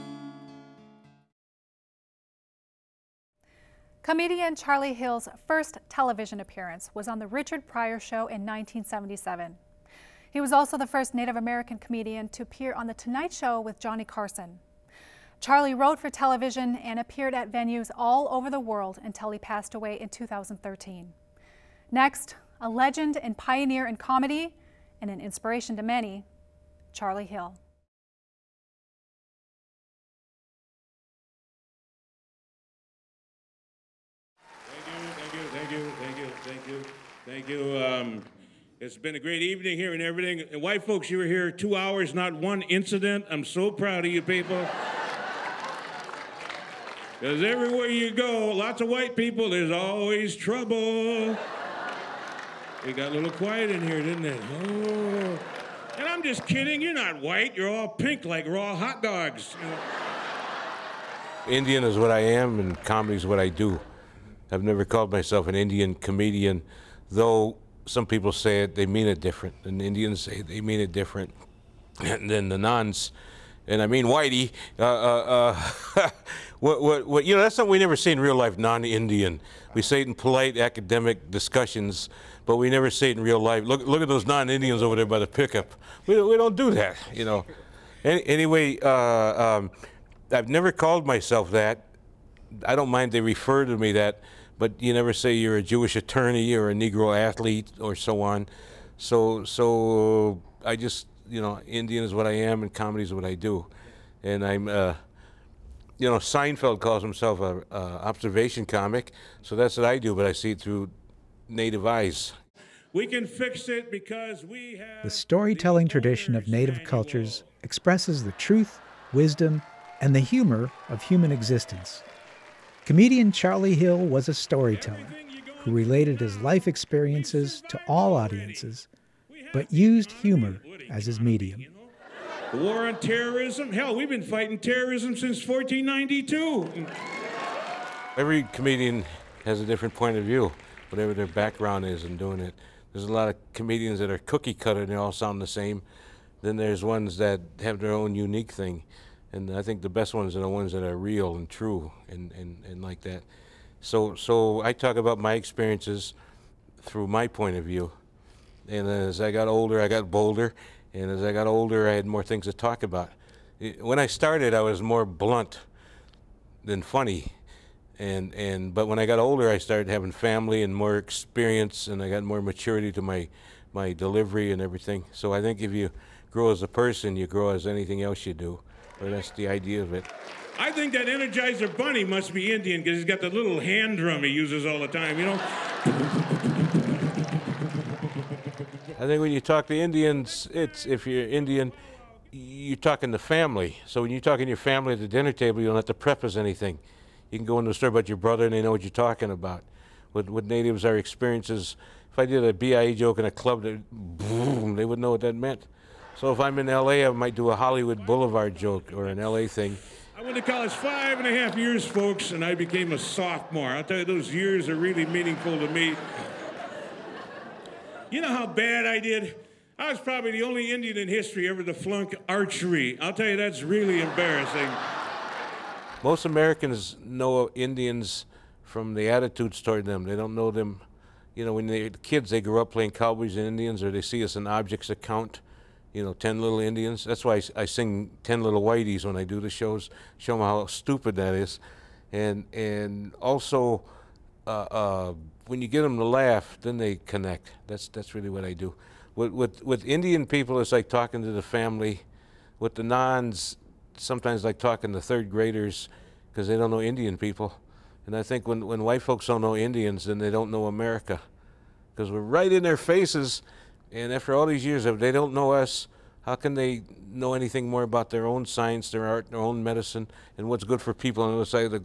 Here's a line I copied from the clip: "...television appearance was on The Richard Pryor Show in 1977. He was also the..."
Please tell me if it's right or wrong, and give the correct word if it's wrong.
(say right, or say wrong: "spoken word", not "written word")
right.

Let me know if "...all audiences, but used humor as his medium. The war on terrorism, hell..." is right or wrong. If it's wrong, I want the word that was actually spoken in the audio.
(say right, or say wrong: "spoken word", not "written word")
right.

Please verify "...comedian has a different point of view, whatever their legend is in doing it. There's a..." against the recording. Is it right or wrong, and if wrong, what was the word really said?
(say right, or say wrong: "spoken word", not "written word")
wrong: "background", not "legend".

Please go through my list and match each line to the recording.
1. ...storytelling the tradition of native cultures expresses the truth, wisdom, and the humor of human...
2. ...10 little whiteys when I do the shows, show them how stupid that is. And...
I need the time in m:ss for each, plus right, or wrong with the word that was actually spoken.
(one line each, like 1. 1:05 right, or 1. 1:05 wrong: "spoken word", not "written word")
1. 1:55 right
2. 3:58 right.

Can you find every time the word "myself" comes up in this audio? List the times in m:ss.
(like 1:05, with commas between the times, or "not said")
1:05, 1:31.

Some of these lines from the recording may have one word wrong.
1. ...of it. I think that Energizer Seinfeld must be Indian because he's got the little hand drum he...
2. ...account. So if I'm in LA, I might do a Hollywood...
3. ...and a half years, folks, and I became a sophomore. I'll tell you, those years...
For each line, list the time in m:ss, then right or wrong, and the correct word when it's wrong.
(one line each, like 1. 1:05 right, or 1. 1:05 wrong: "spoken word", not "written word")
1. 2:59 wrong: "Bunny", not "Seinfeld"
2. 3:25 wrong: "meant", not "account"
3. 3:31 right.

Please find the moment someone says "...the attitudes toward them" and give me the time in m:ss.
3:48.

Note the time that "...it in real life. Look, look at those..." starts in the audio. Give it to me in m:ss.
1:23.